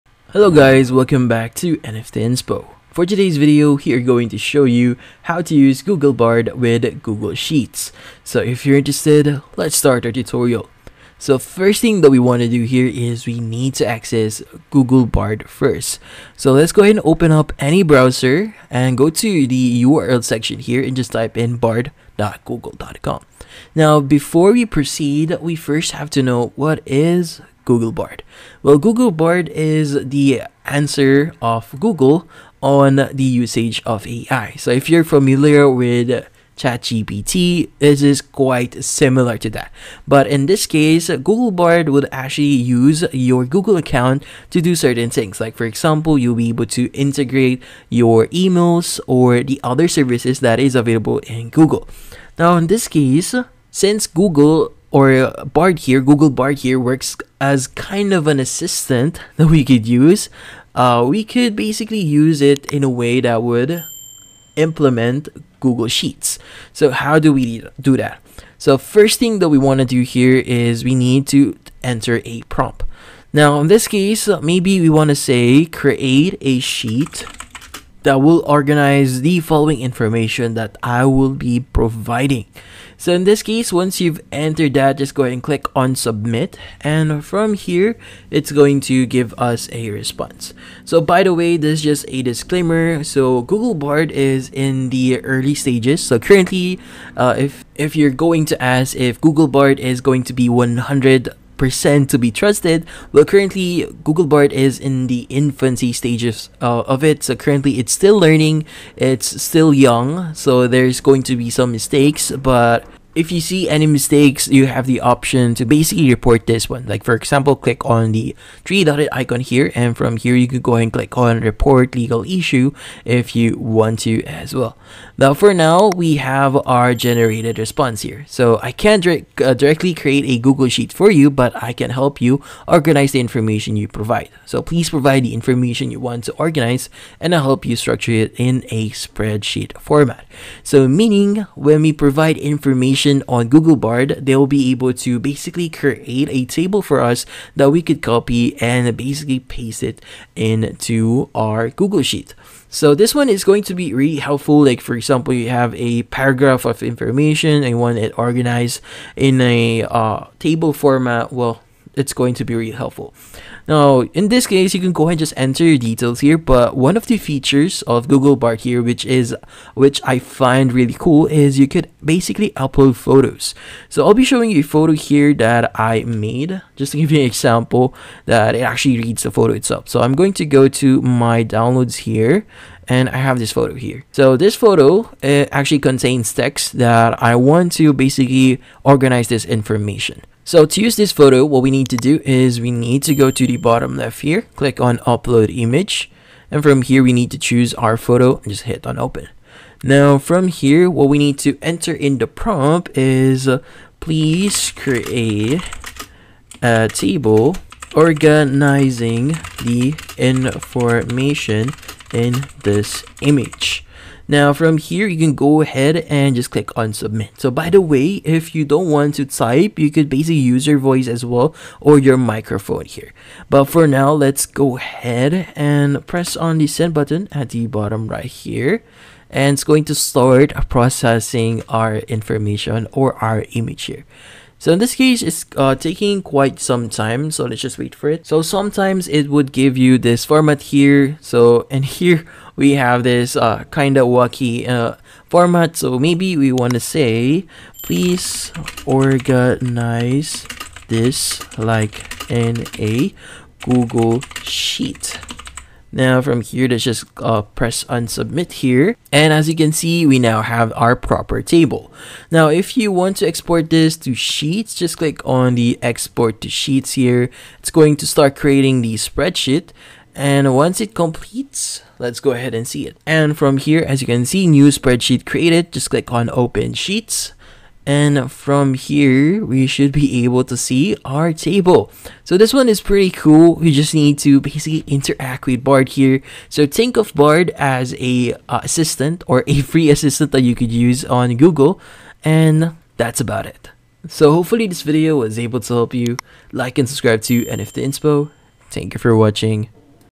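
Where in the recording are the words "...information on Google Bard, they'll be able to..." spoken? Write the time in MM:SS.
02:22.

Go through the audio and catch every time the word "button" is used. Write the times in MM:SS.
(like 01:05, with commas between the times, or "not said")
03:46.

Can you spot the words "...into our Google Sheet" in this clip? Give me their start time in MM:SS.
02:30.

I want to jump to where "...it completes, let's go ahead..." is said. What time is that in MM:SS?
04:30.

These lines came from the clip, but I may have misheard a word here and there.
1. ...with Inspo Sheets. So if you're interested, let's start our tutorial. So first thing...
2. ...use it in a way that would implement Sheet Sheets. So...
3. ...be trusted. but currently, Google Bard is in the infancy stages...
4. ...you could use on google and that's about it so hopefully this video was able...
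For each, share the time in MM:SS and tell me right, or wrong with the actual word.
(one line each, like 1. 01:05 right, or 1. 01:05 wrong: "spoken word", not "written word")
1. 00:06 wrong: "Google", not "Inspo"
2. 01:01 wrong: "Google", not "Sheet"
3. 01:42 right
4. 04:50 right.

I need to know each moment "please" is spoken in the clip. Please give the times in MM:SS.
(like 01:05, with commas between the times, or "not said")
02:14, 03:23, 04:07.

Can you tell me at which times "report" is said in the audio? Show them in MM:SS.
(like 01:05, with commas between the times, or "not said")
01:56, 02:01.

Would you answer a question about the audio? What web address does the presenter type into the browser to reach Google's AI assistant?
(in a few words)
bard.google.com.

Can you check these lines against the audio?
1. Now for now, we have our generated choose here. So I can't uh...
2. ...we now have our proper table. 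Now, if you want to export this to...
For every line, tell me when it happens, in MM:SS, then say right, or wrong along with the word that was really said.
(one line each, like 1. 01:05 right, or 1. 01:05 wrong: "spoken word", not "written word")
1. 02:05 wrong: "response", not "choose"
2. 04:20 right.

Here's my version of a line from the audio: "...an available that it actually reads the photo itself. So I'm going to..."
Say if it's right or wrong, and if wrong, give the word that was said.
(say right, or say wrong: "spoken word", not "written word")
wrong: "example", not "available".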